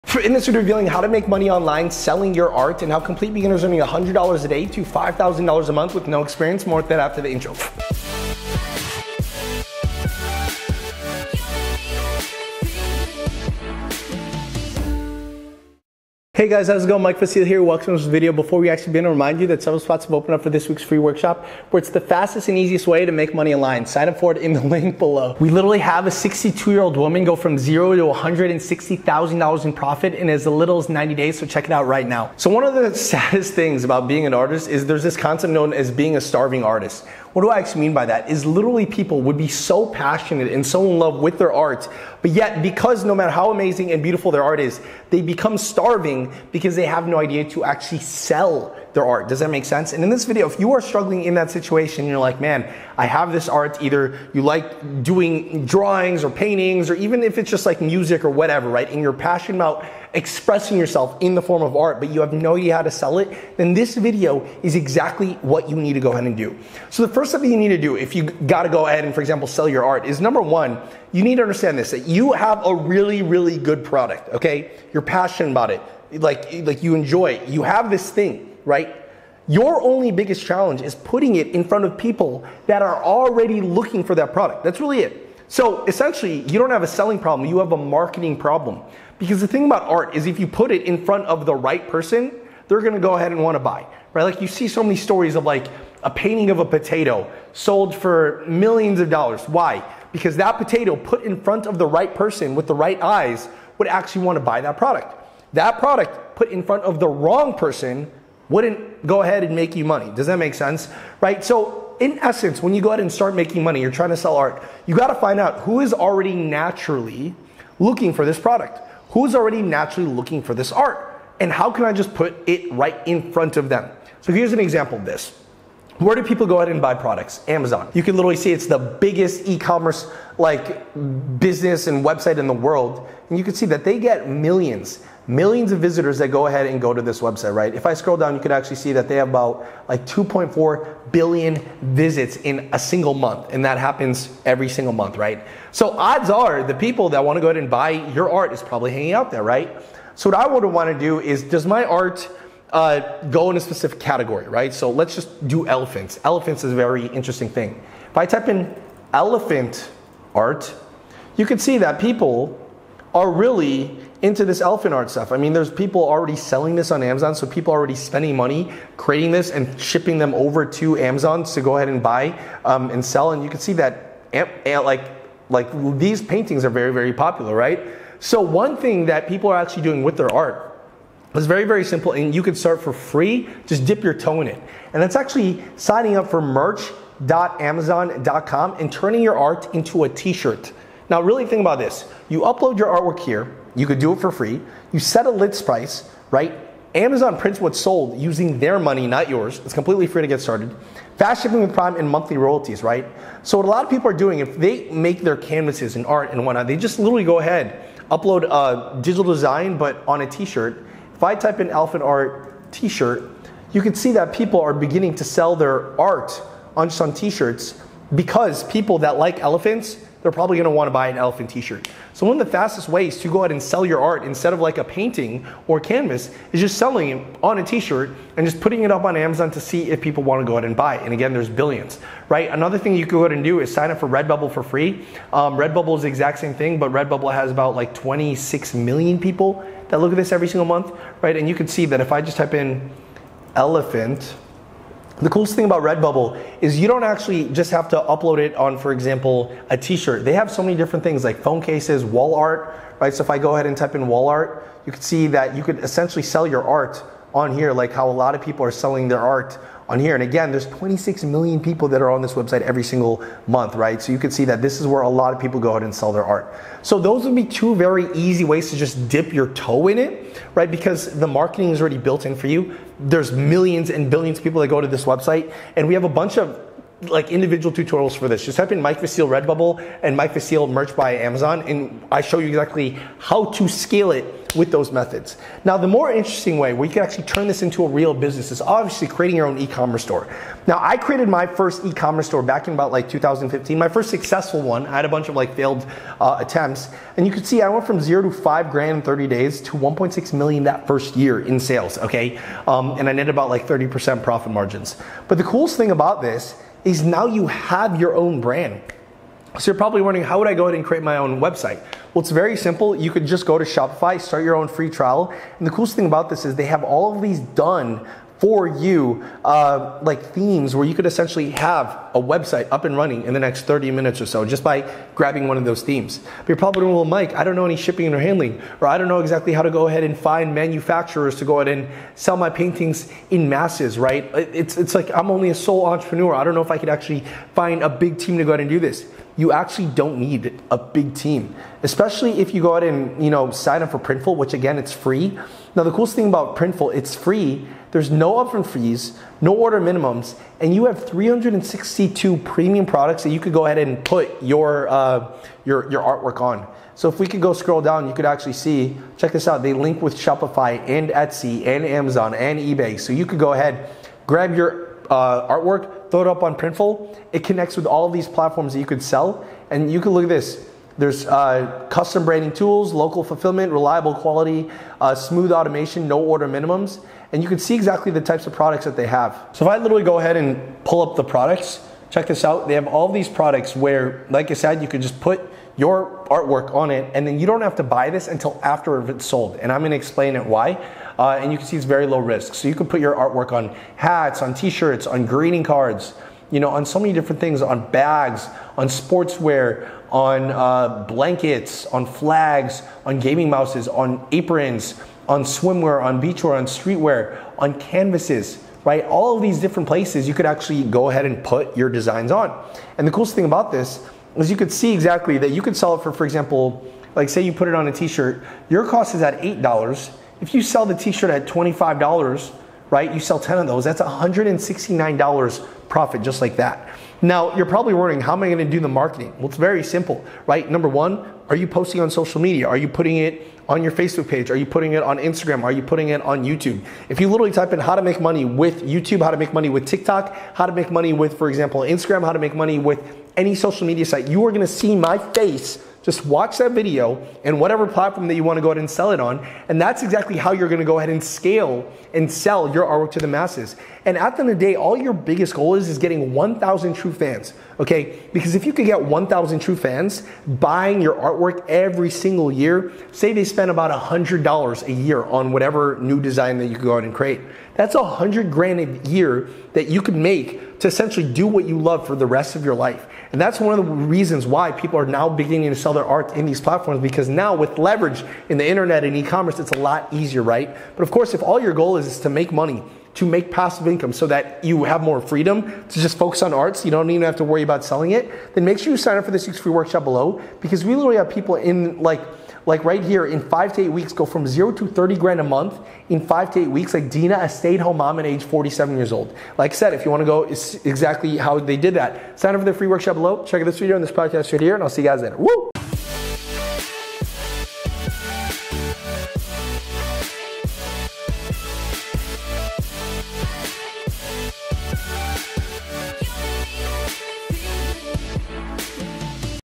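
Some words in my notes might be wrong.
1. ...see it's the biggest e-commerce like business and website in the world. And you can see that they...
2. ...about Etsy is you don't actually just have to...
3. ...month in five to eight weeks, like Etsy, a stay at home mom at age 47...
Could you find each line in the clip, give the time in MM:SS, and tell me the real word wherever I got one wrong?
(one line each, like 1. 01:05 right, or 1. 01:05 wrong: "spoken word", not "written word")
1. 02:08 right
2. 04:05 wrong: "Redbubble", not "Etsy"
3. 08:15 wrong: "Dina", not "Etsy".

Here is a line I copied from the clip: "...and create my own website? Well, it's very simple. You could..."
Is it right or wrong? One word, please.
right.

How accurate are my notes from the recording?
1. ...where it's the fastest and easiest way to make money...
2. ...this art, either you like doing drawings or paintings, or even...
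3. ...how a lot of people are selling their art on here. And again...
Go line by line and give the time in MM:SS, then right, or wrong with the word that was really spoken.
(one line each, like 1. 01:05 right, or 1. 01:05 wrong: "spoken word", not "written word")
1. 00:21 right
2. 00:53 right
3. 04:17 right.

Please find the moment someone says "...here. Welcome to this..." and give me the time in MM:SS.
00:17.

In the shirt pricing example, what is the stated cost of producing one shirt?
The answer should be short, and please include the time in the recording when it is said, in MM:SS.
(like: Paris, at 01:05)
$8, at 06:59.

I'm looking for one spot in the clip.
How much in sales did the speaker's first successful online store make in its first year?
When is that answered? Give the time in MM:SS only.
04:59.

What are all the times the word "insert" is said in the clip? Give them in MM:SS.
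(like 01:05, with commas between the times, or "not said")
not said.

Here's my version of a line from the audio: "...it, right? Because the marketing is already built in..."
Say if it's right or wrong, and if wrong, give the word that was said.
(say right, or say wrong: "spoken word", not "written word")
right.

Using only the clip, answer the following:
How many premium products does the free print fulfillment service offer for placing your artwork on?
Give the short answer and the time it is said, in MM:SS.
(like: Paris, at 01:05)
362, at 05:51.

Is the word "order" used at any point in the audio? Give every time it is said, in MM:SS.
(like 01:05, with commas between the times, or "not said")
05:49, 06:16.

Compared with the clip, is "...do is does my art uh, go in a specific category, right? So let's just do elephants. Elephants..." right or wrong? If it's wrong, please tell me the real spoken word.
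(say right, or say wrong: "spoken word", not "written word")
right.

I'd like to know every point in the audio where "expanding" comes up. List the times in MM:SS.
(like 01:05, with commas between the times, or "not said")
not said.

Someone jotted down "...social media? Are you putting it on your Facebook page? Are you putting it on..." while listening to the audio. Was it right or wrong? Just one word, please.
right.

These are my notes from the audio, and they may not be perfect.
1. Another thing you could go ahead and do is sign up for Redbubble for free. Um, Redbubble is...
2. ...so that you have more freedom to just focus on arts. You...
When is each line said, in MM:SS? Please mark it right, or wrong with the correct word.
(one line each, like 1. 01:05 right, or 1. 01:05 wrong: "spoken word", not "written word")
1. 03:52 right
2. 08:04 right.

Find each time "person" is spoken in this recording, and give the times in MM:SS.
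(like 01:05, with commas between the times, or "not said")
01:31, 01:42, 01:47.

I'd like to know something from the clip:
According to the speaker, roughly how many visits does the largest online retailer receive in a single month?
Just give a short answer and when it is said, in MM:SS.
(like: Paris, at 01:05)
2.4 billion, at 02:20.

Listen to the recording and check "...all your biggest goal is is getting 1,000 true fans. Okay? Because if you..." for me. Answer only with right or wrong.
right.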